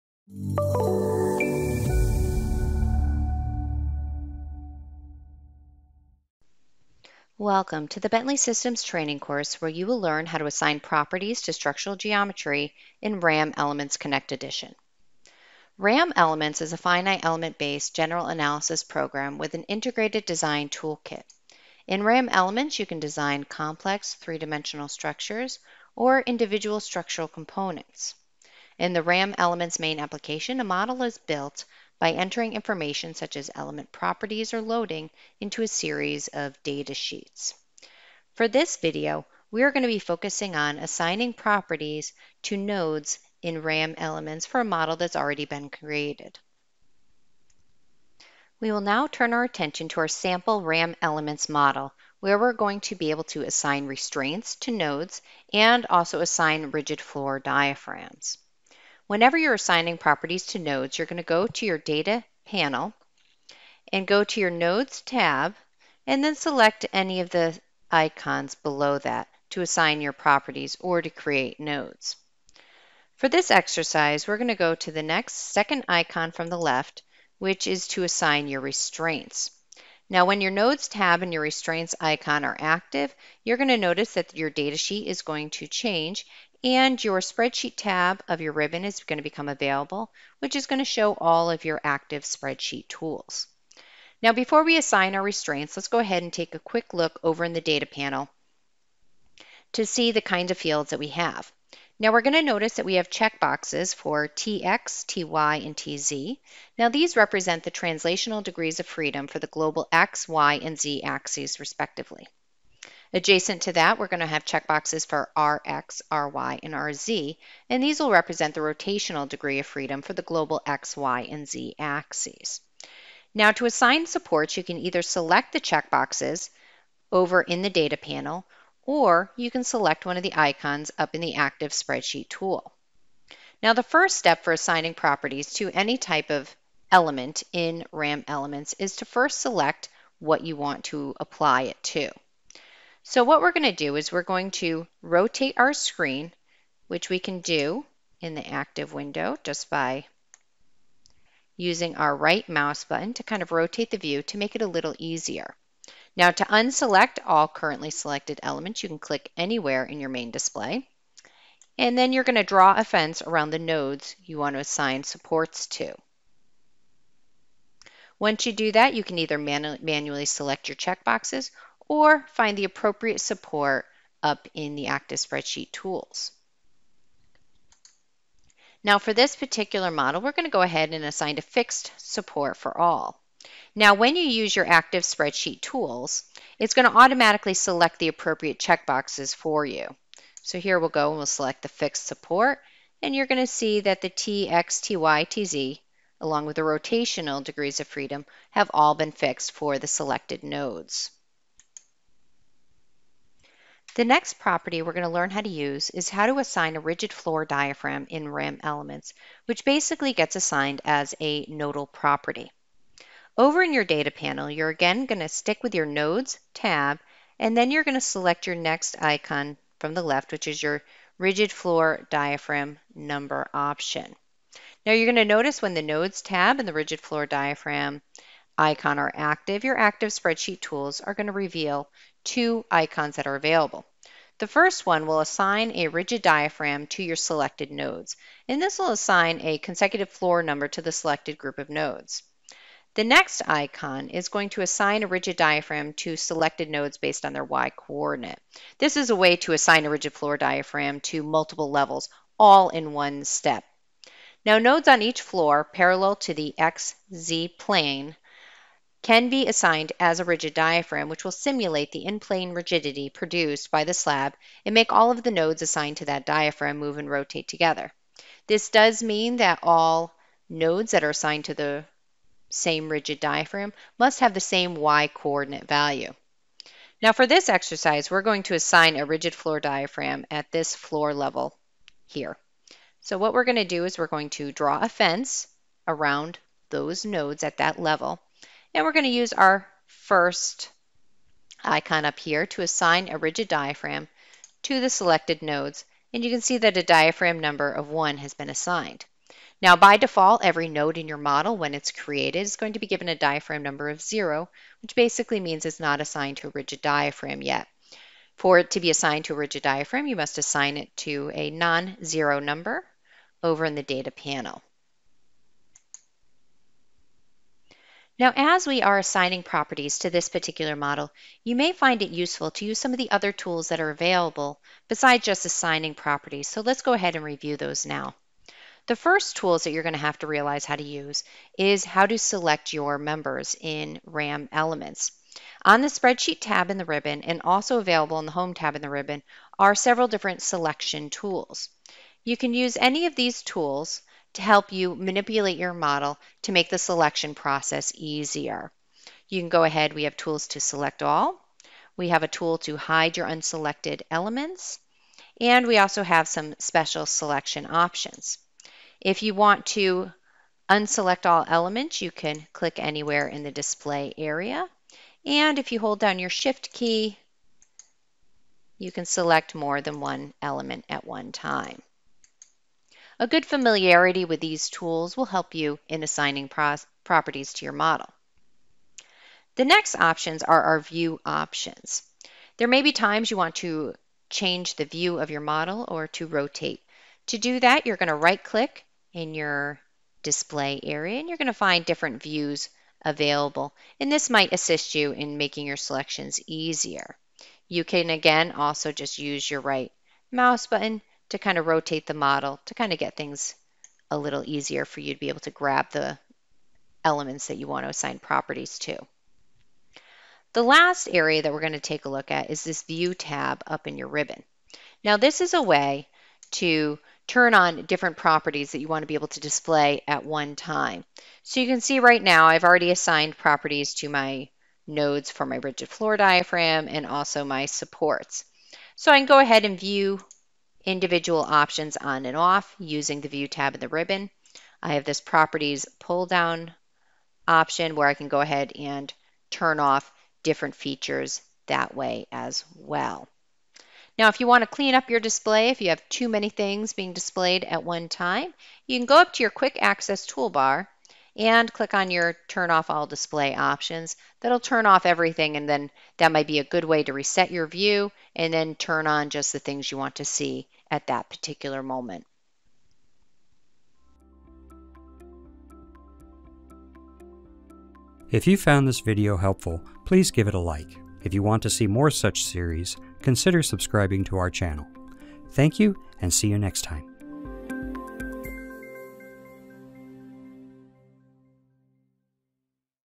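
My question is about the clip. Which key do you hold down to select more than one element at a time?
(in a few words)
Shift.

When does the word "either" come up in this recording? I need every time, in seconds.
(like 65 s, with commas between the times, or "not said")
124 s, 169 s.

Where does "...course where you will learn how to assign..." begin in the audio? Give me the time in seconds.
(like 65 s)
9 s.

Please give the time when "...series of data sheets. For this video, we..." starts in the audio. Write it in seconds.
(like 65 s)
35 s.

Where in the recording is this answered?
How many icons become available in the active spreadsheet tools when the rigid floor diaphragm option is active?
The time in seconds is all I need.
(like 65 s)
232 s.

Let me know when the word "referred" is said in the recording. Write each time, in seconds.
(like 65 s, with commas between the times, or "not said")
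not said.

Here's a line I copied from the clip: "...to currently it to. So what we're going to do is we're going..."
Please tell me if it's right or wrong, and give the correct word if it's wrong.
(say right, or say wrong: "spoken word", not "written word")
wrong: "apply", not "currently".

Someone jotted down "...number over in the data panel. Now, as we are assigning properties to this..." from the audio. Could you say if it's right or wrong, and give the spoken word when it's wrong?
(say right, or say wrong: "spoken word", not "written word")
right.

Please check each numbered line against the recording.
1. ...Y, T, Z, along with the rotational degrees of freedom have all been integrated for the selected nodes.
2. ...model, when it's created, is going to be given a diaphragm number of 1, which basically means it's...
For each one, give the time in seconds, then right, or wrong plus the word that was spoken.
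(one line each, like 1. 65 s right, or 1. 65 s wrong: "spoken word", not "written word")
1. 194 s wrong: "fixed", not "integrated"
2. 301 s wrong: "0", not "1".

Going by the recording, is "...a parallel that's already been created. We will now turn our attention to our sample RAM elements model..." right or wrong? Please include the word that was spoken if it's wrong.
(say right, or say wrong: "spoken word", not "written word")
wrong: "model", not "parallel".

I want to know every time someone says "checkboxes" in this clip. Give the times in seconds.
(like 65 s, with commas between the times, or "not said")
103 s, 114 s, 125 s, 170 s, 188 s.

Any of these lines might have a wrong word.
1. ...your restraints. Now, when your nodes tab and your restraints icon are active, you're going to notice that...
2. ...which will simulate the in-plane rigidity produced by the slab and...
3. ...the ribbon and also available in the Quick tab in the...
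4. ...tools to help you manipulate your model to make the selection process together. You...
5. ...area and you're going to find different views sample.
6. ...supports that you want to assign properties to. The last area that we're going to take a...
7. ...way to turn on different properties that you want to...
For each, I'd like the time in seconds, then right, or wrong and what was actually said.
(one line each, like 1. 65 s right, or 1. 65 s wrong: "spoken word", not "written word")
1. 78 s right
2. 261 s right
3. 336 s wrong: "Home", not "Quick"
4. 343 s wrong: "easier", not "together"
5. 390 s wrong: "available", not "sample"
6. 407 s wrong: "elements", not "supports"
7. 415 s right.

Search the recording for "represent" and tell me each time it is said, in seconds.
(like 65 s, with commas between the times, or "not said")
107 s, 118 s.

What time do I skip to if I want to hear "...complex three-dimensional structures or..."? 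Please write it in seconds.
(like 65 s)
23 s.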